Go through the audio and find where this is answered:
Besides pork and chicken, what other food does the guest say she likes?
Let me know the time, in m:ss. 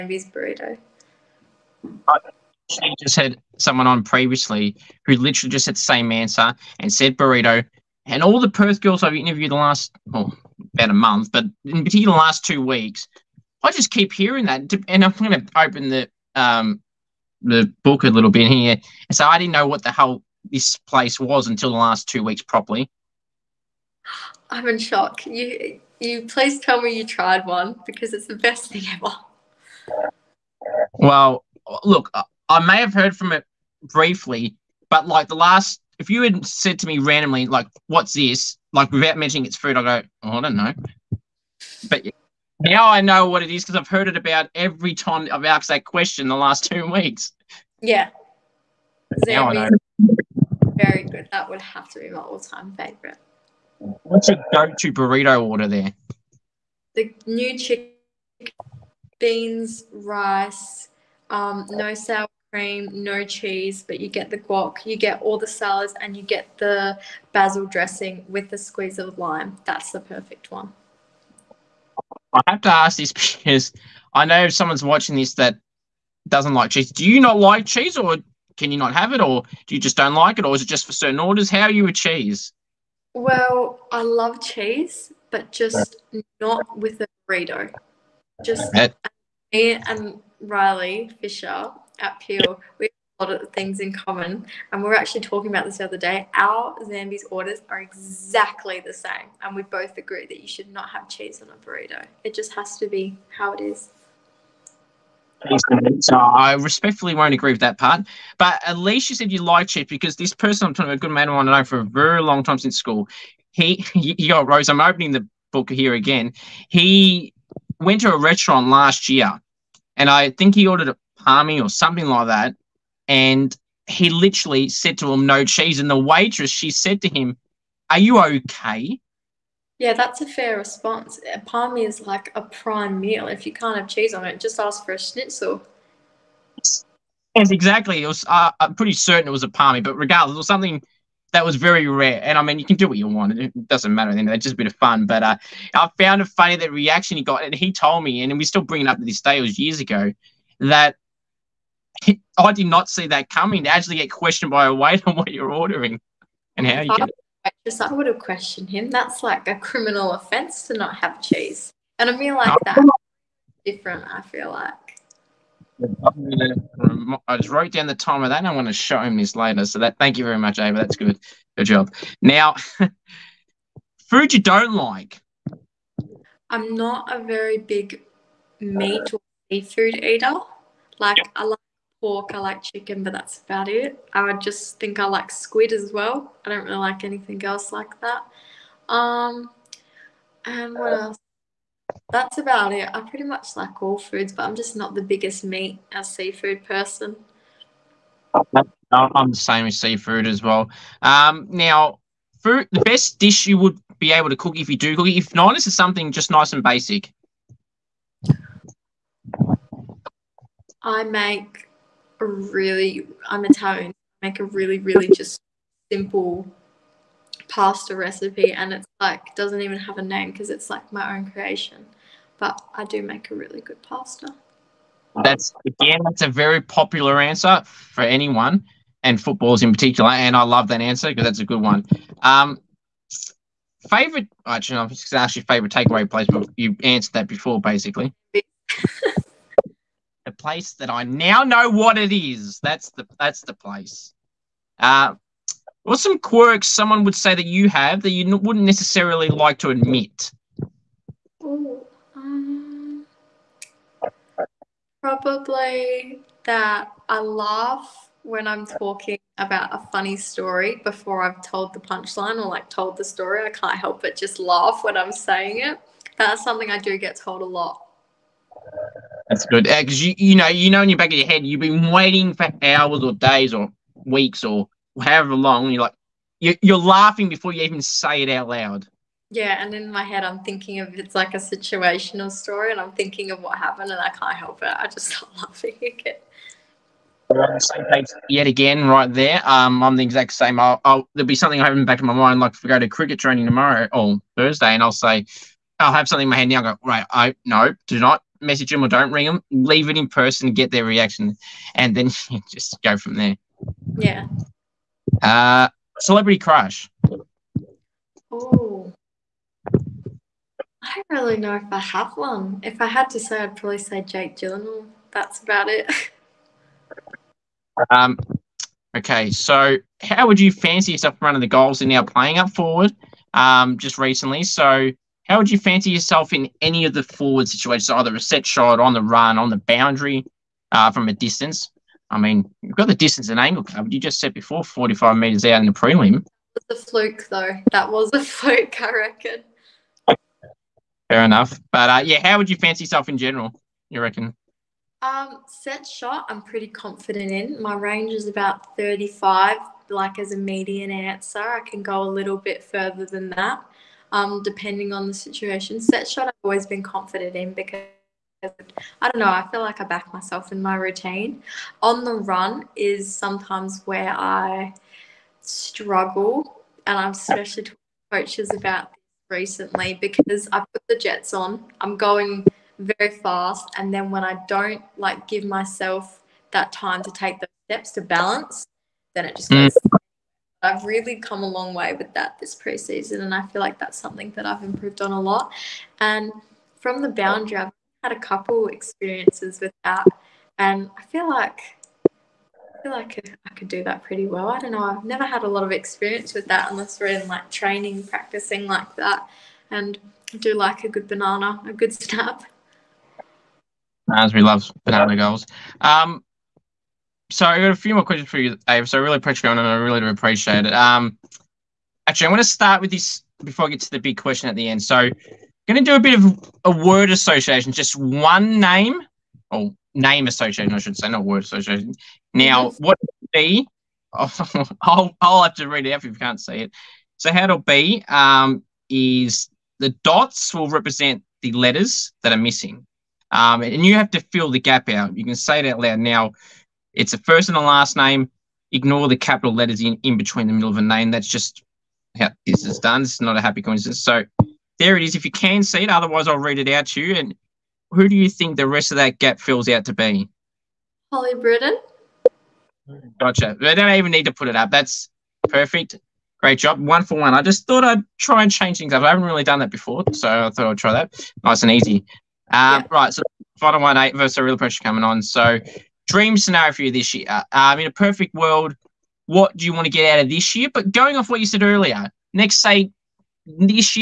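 3:05.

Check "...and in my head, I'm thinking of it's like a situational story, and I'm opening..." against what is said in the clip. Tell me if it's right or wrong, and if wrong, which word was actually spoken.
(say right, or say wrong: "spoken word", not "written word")
wrong: "thinking", not "opening".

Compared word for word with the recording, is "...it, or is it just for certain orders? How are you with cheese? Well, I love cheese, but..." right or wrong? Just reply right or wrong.
right.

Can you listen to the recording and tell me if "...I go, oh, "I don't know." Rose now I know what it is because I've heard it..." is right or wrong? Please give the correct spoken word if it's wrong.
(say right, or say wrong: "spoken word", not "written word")
wrong: "But", not "Rose".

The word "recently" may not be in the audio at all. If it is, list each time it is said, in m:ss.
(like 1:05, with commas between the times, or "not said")
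5:23, 6:09.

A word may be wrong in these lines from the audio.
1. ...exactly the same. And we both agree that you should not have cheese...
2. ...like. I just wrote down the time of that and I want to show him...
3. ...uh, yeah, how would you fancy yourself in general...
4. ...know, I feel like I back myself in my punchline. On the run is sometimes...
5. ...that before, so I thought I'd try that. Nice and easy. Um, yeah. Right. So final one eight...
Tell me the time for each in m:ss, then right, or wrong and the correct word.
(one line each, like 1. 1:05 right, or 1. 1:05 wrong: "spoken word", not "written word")
1. 1:37 right
2. 2:44 right
3. 5:41 right
4. 5:59 wrong: "routine", not "punchline"
5. 7:39 right.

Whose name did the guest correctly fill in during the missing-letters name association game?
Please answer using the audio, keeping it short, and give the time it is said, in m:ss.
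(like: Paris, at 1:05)
Holly Britton, at 7:31.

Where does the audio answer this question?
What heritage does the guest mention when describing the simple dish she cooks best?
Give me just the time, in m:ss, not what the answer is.
3:33.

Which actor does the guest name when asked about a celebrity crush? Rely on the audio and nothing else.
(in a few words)
Jake Gyllenhaal.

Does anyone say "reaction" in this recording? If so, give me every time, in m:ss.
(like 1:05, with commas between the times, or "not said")
2:26, 5:00.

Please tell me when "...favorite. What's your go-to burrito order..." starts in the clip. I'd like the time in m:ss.
0:52.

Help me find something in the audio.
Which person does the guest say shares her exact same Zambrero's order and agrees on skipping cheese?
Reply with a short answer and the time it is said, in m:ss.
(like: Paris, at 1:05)
Riley Fisher, at 1:30.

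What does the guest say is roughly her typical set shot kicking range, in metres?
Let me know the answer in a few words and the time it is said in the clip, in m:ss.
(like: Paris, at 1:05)
35, at 5:48.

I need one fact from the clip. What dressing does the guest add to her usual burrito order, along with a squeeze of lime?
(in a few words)
basil dressing.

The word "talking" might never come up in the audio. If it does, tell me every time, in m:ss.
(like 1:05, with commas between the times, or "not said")
1:35, 1:50, 4:18, 6:07.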